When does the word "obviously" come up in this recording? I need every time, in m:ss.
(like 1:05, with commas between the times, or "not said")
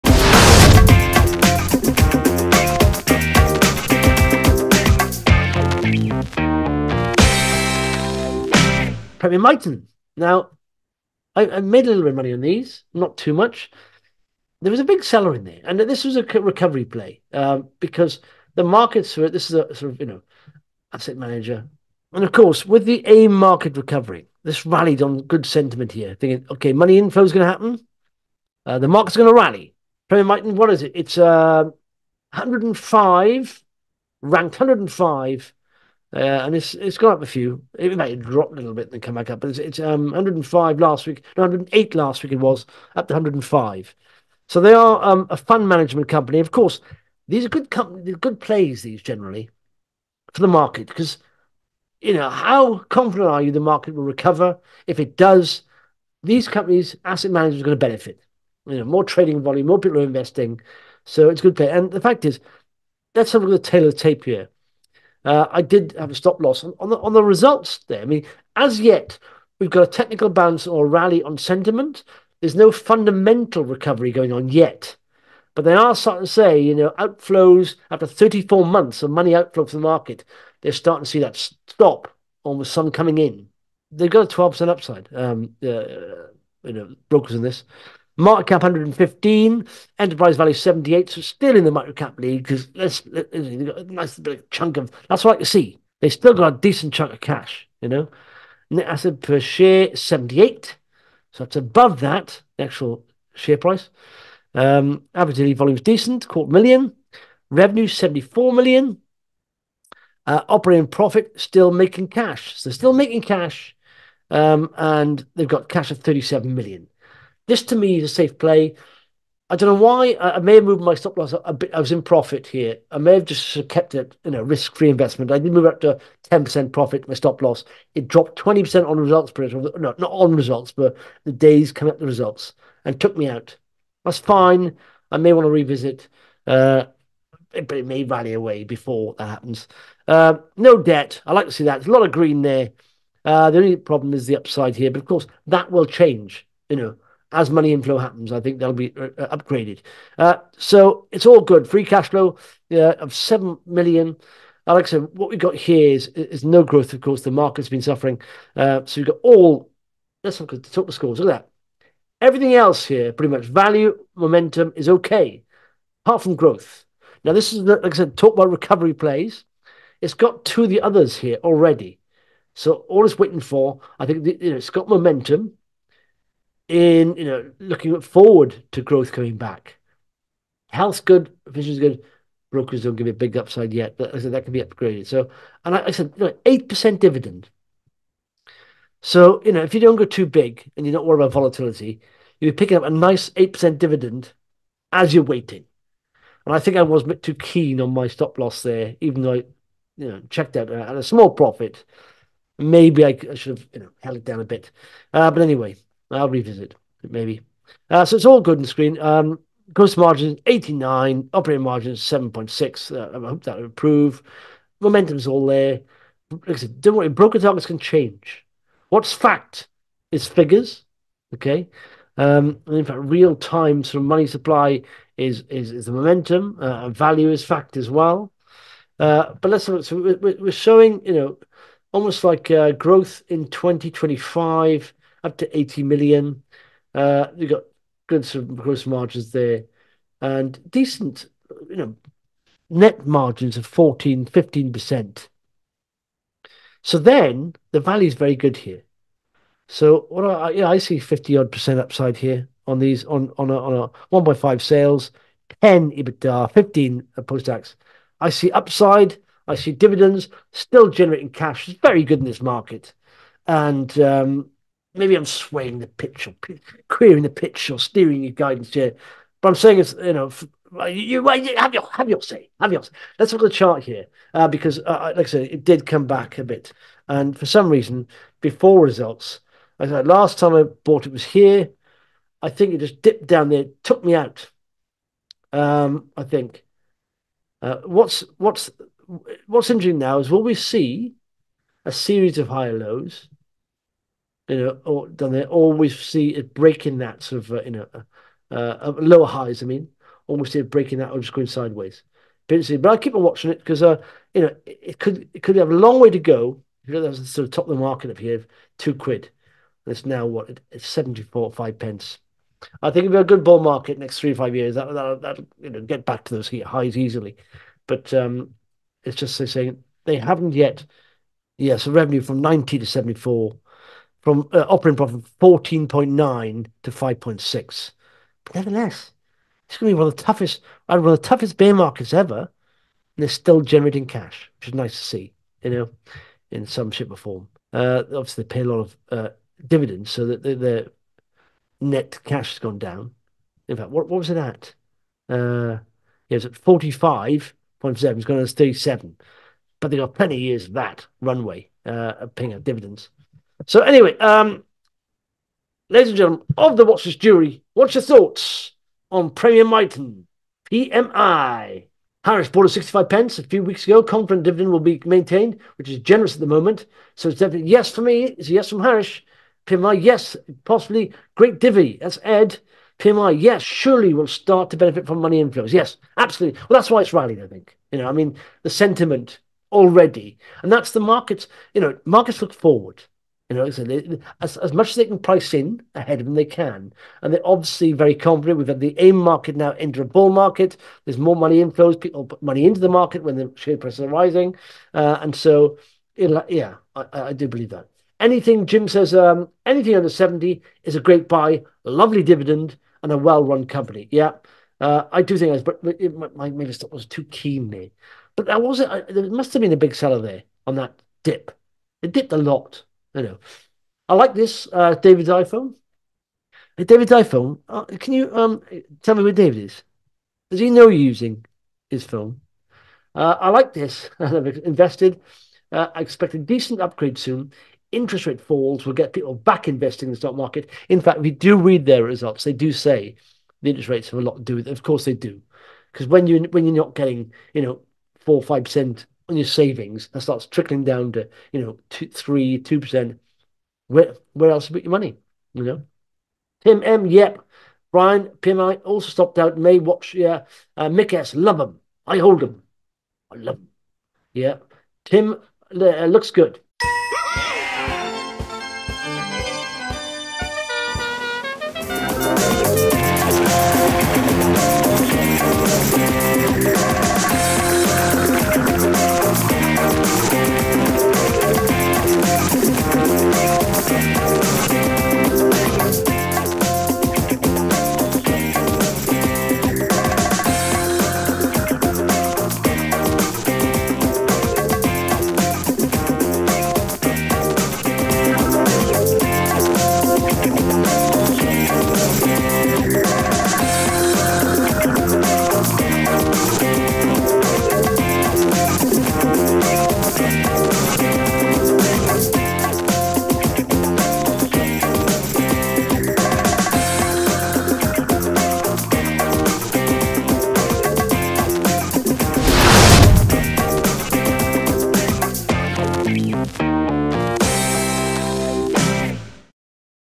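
5:38, 6:27.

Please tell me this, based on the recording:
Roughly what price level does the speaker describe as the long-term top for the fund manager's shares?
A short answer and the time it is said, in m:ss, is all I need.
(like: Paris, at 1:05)
two quid, at 5:08.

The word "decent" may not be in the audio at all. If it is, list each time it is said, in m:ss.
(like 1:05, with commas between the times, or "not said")
1:36, 1:45, 4:00, 7:06.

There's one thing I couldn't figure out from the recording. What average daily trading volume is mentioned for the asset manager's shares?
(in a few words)
quarter million.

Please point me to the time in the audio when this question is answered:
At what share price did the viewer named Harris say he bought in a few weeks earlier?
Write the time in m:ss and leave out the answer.
6:02.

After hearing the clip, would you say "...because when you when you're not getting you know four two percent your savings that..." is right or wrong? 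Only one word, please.
wrong.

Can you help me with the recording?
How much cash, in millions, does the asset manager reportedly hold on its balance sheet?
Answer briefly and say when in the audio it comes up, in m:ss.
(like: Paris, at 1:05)
37 million, at 1:55.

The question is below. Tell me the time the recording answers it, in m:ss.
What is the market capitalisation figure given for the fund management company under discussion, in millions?
1:28.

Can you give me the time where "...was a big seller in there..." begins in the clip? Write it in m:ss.
0:14.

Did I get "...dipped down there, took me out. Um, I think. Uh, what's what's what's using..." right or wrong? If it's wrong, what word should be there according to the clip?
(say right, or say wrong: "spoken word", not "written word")
wrong: "interesting", not "using".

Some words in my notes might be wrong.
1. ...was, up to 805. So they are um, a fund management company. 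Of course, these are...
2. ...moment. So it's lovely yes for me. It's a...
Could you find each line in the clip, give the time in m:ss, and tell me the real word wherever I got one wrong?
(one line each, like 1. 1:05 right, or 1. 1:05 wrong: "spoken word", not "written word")
1. 0:42 wrong: "105", not "805"
2. 6:06 wrong: "definitely", not "lovely".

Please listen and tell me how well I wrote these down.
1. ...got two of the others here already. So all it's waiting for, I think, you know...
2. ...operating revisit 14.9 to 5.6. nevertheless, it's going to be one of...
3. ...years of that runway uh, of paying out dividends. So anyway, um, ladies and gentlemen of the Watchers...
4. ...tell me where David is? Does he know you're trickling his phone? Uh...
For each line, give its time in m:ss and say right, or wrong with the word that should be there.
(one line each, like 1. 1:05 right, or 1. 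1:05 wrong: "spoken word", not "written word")
1. 2:50 right
2. 5:24 wrong: "profit", not "revisit"
3. 5:50 right
4. 6:59 wrong: "using", not "trickling".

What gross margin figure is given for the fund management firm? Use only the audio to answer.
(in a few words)
89.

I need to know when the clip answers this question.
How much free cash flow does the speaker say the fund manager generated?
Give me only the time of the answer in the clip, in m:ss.
2:33.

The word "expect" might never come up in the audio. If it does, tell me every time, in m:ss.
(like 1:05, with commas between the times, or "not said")
7:06.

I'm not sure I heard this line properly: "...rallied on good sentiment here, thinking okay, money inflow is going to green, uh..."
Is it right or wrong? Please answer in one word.
wrong.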